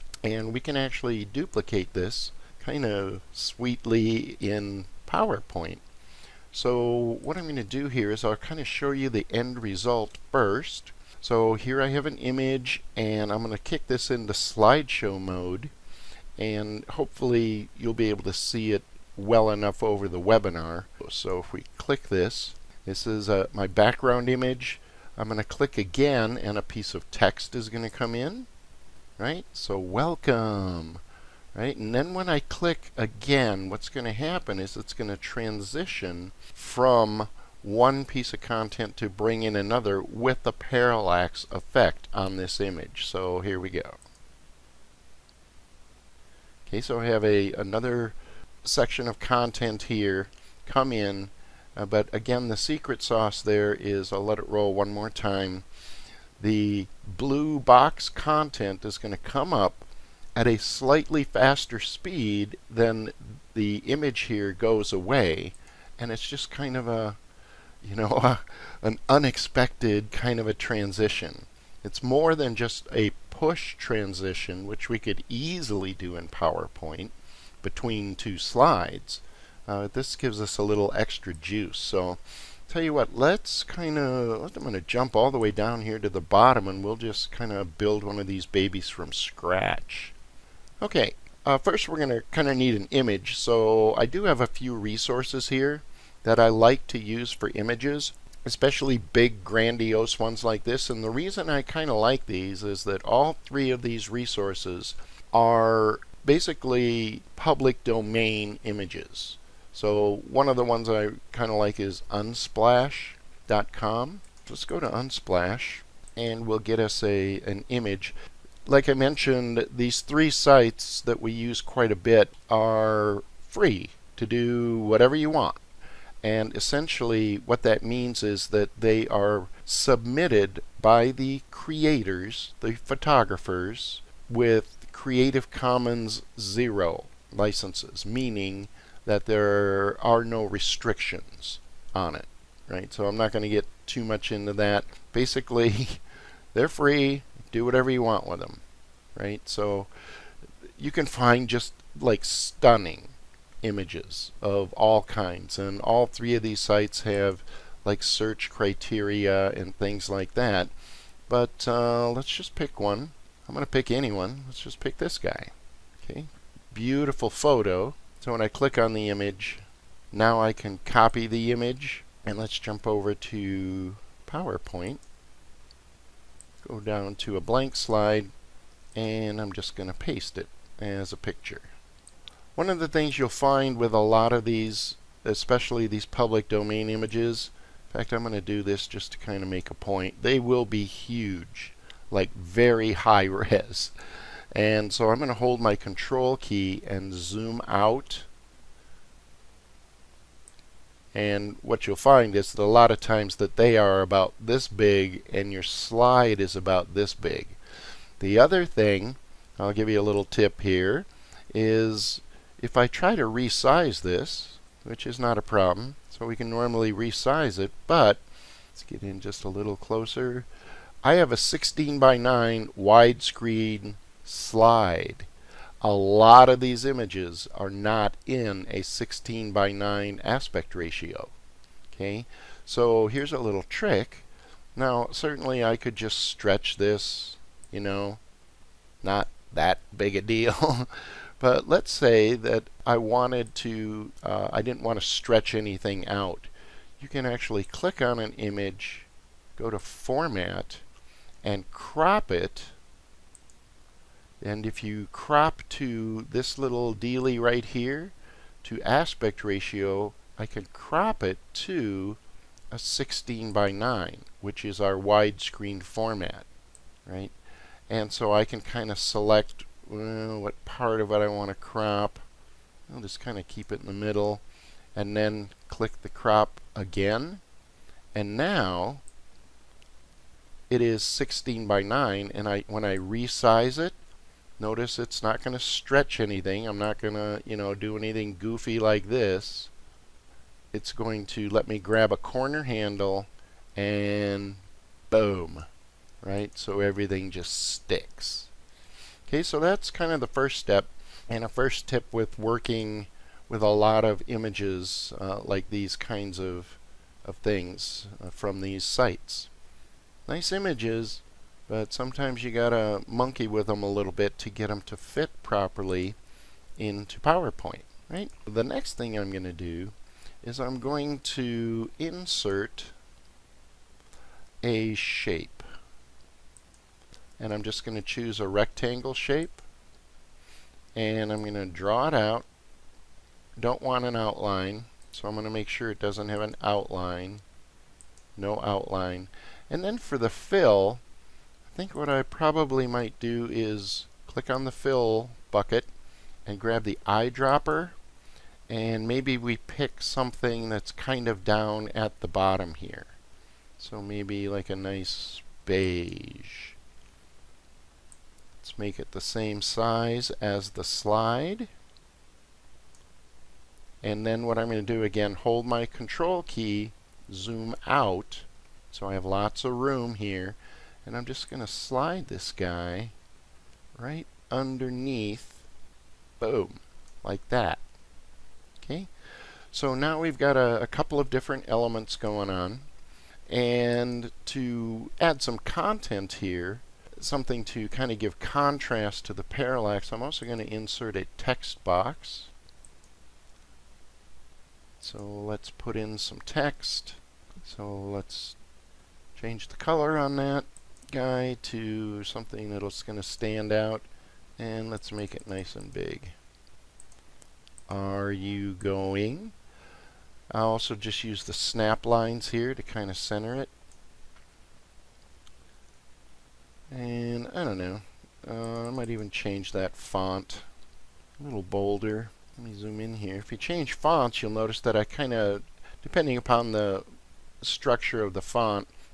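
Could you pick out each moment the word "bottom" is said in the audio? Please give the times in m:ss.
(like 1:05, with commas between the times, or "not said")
1:26, 5:52.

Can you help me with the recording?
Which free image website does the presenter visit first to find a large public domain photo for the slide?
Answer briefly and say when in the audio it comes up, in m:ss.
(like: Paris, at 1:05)
unsplash.com, at 1:52.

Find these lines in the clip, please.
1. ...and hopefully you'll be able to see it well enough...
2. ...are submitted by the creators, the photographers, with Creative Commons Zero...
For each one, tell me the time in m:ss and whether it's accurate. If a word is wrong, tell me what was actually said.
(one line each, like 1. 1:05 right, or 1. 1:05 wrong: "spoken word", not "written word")
1. 0:16 right
2. 2:09 right.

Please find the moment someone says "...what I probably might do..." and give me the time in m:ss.
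5:41.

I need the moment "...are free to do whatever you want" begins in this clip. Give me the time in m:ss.
2:02.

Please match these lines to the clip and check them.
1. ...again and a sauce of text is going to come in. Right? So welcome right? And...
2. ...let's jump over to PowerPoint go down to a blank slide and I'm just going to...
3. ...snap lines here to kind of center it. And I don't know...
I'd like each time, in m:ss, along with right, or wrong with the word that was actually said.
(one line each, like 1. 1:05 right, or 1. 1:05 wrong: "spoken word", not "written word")
1. 0:25 wrong: "piece", not "sauce"
2. 2:52 right
3. 6:51 right.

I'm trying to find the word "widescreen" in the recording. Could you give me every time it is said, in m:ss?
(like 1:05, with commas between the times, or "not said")
3:42, 4:24.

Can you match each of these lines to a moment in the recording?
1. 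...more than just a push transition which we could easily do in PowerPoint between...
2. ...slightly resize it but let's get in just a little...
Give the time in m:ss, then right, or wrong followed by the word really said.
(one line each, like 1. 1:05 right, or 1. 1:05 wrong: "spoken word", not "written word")
1. 1:12 right
2. 3:36 wrong: "normally", not "slightly".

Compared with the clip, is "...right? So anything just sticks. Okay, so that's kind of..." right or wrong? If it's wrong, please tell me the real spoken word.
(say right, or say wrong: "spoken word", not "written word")
wrong: "everything", not "anything".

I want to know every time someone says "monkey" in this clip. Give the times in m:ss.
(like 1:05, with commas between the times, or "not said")
5:13.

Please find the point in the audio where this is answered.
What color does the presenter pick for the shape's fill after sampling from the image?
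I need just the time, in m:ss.
5:55.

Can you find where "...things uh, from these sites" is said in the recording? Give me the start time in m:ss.
5:07.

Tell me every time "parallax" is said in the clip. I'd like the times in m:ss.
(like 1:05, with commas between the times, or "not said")
0:40, 6:29.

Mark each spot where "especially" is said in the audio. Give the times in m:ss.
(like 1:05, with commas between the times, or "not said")
1:38, 3:05.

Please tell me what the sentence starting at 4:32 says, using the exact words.
I'll just kind of keep it in the middle and then click the crop again.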